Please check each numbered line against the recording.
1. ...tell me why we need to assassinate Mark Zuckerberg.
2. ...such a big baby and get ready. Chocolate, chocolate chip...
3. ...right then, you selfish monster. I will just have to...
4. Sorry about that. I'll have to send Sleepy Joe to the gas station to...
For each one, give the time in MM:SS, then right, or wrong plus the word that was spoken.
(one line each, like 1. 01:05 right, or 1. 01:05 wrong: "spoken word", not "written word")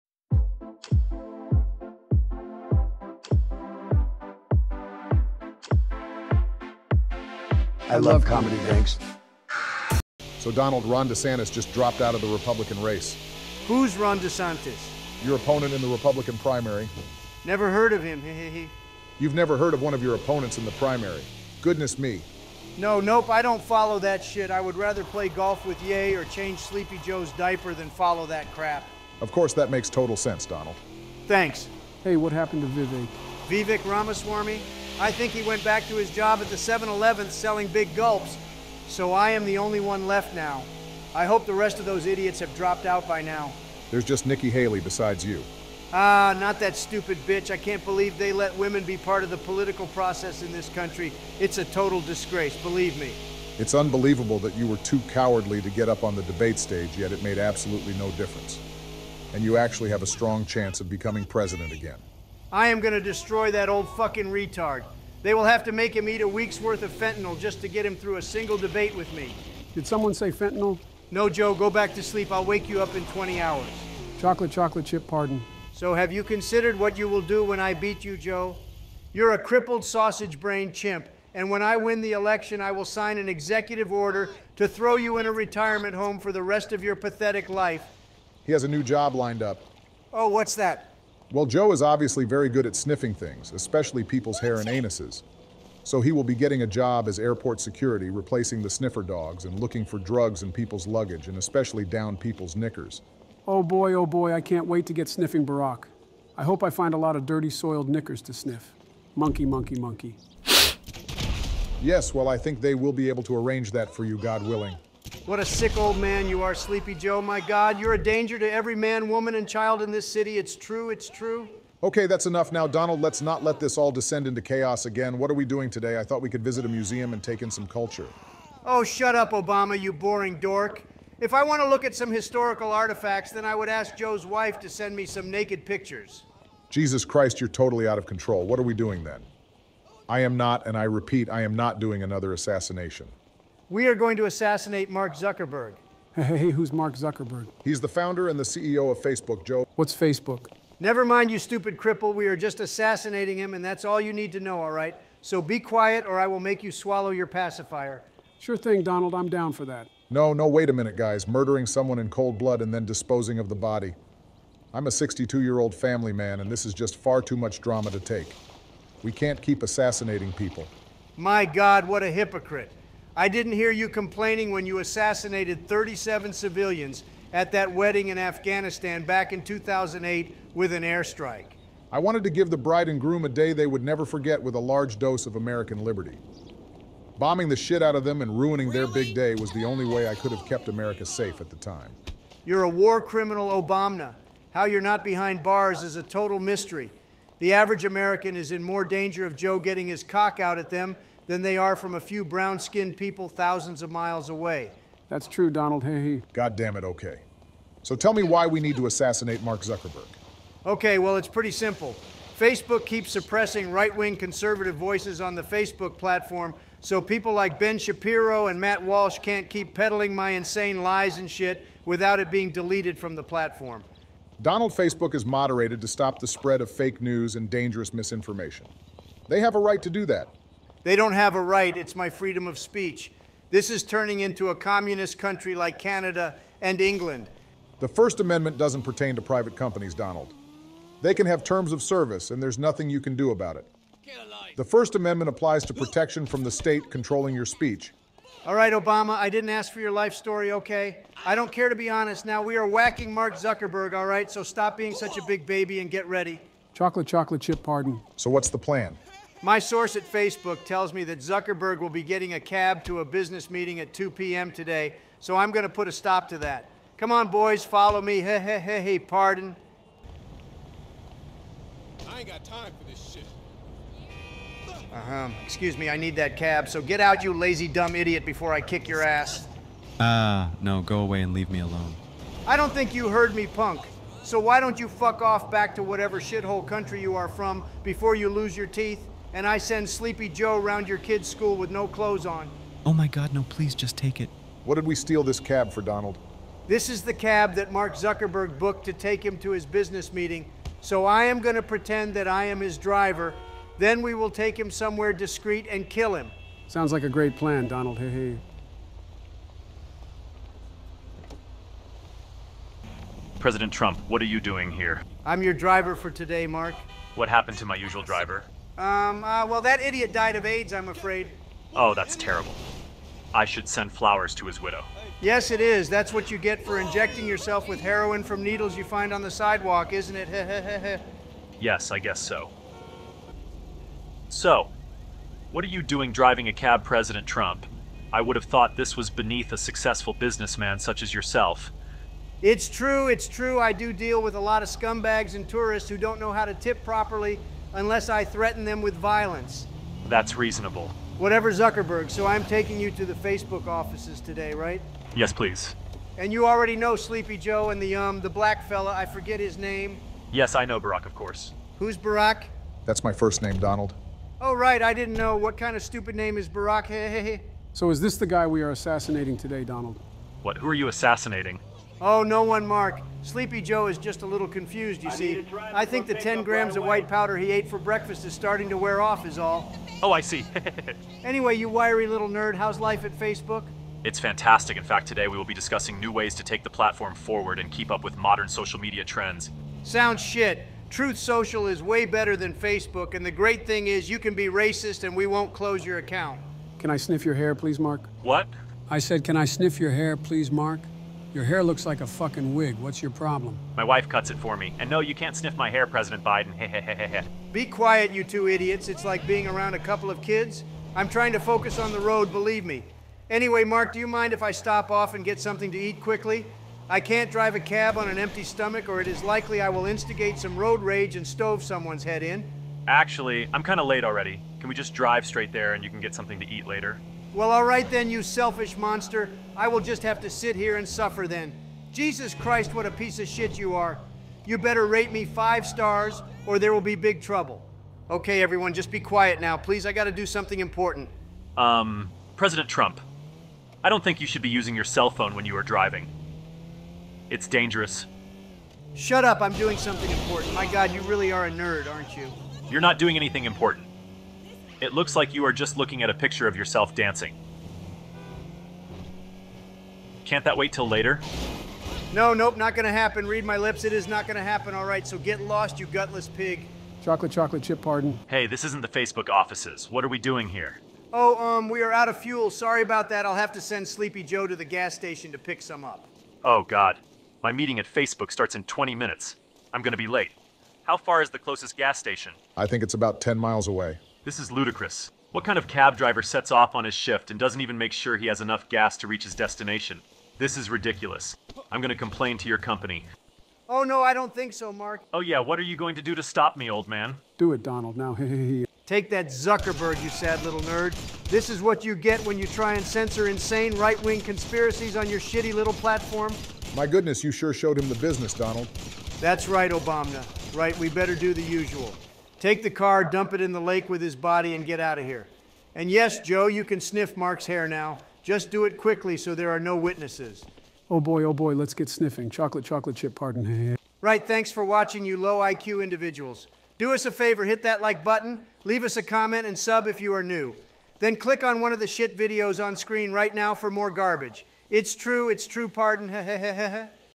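1. 03:27 right
2. 04:14 right
3. 07:07 right
4. 07:52 right.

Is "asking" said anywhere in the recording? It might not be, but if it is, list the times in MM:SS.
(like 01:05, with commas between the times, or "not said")
not said.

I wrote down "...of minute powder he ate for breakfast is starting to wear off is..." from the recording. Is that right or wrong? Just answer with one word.
wrong.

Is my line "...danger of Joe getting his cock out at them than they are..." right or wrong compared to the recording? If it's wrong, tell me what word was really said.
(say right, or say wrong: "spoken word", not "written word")
right.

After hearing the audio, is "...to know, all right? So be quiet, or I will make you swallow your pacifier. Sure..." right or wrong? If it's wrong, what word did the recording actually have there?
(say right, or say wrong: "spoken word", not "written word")
right.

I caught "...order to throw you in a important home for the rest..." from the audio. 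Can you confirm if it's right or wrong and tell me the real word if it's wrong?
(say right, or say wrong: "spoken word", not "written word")
wrong: "retirement", not "important".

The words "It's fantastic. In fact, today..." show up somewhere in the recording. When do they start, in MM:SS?
06:24.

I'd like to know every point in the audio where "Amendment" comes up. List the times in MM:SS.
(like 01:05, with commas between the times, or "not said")
03:58, 04:04.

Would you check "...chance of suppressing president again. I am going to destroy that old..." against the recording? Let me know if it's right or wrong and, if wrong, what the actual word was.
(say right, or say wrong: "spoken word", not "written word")
wrong: "becoming", not "suppressing".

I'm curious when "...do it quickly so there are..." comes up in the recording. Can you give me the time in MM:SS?
08:38.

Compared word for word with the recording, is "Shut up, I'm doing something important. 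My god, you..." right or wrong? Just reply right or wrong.
right.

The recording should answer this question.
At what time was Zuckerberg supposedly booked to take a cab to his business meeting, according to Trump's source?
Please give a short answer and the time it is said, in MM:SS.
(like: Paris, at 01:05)
2 p.m., at 04:23.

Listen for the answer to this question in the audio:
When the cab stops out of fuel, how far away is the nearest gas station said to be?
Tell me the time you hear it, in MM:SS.
08:03.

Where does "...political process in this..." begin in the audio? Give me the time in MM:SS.
00:49.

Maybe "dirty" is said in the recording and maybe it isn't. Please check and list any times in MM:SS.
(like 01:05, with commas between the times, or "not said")
01:47.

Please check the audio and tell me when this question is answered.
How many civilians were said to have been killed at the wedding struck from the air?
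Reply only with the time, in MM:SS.
02:55.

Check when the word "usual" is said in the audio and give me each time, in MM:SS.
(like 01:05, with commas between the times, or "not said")
05:17, 08:31.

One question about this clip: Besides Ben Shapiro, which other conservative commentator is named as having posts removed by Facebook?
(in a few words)
Matt Walsh.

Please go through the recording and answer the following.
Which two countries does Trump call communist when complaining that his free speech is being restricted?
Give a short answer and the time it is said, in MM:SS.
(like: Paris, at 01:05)
Canada and England, at 03:55.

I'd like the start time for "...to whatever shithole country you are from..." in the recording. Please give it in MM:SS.
04:45.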